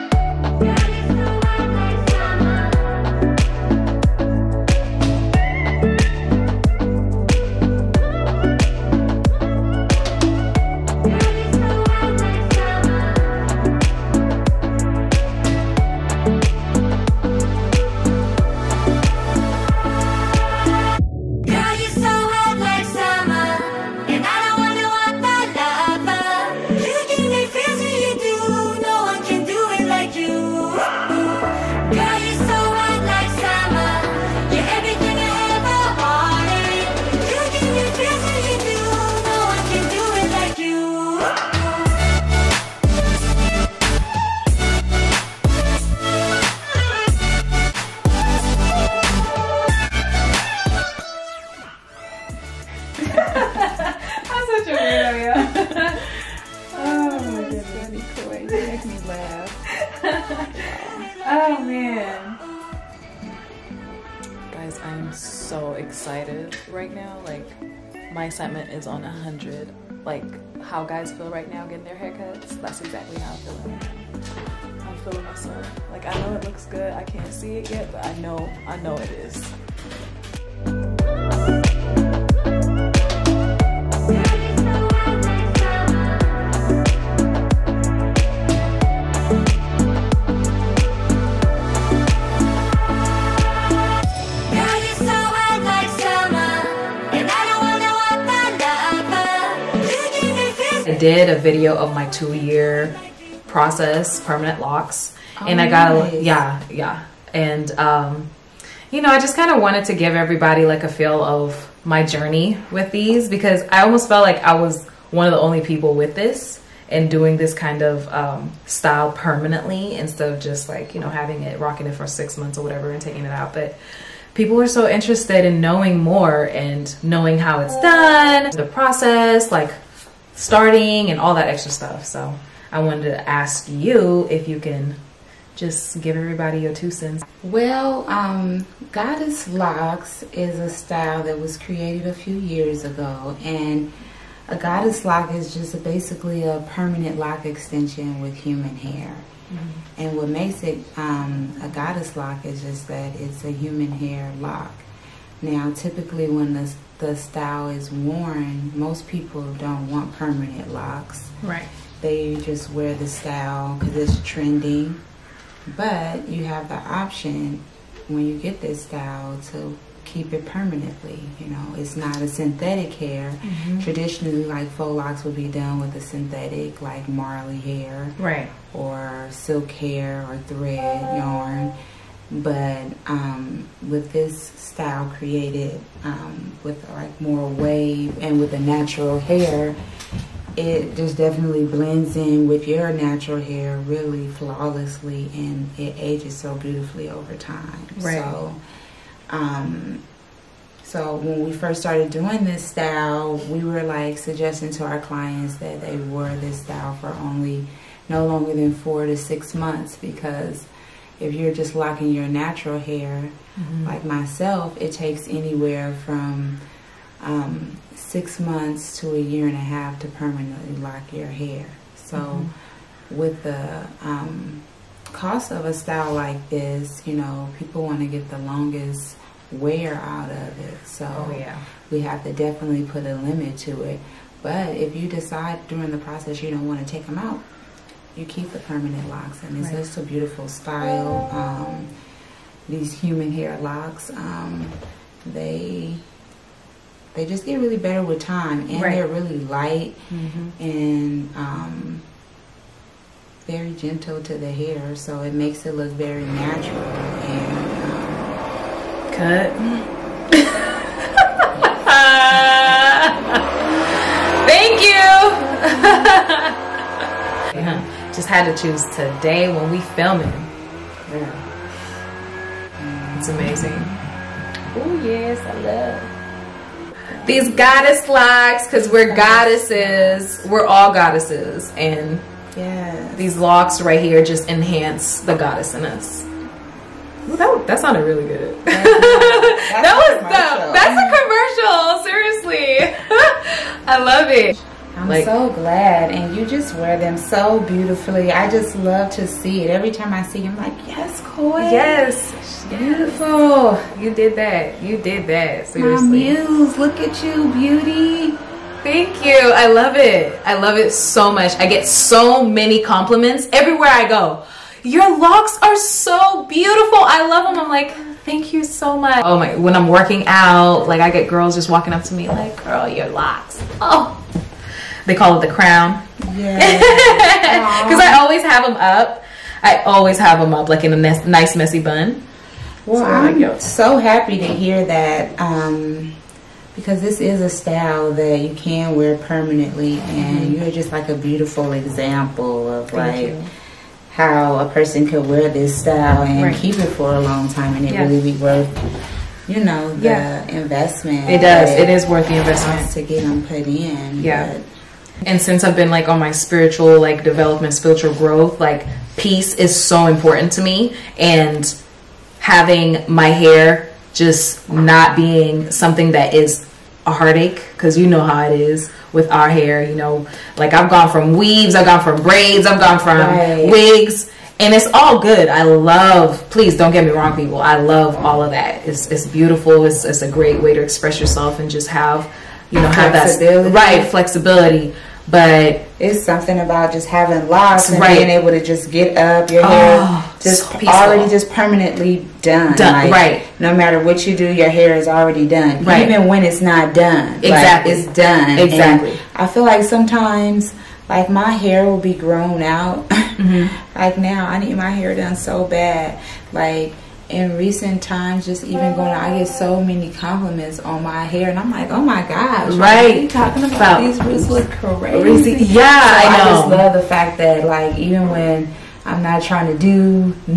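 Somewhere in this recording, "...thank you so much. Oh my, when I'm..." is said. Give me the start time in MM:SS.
05:18.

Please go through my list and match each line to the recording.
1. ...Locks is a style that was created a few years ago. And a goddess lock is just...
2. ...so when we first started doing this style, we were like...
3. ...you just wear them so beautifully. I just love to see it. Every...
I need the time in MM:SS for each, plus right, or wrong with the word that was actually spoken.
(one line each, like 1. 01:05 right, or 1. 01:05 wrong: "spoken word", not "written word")
1. 02:19 right
2. 03:20 right
3. 04:56 right.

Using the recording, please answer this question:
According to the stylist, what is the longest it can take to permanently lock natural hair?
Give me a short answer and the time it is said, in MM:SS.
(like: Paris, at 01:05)
a year and a half, at 03:39.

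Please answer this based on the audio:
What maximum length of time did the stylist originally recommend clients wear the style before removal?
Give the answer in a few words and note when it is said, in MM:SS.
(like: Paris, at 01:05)
4 to 6 months, at 03:28.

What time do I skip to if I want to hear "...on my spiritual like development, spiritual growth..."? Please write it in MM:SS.
05:56.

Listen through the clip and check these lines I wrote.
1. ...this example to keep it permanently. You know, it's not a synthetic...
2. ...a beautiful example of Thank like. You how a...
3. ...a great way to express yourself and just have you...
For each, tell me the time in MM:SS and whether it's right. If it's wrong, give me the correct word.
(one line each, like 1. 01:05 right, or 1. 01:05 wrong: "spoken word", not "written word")
1. 02:48 wrong: "style", not "example"
2. 05:41 right
3. 06:20 right.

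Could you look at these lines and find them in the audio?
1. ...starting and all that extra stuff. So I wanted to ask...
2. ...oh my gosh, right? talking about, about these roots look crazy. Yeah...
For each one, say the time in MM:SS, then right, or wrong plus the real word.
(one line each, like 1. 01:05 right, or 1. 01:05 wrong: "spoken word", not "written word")
1. 02:10 right
2. 06:51 right.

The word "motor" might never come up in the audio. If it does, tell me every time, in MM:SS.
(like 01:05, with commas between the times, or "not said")
not said.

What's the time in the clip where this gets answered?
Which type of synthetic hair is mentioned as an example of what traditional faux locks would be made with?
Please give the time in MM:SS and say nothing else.
02:57.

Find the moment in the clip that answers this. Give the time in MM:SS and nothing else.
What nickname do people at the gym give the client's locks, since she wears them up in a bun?
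05:25.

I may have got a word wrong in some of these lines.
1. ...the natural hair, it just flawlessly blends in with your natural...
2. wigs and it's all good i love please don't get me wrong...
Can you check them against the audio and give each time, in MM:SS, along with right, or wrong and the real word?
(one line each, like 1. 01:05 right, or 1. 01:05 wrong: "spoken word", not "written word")
1. 03:08 wrong: "definitely", not "flawlessly"
2. 06:13 right.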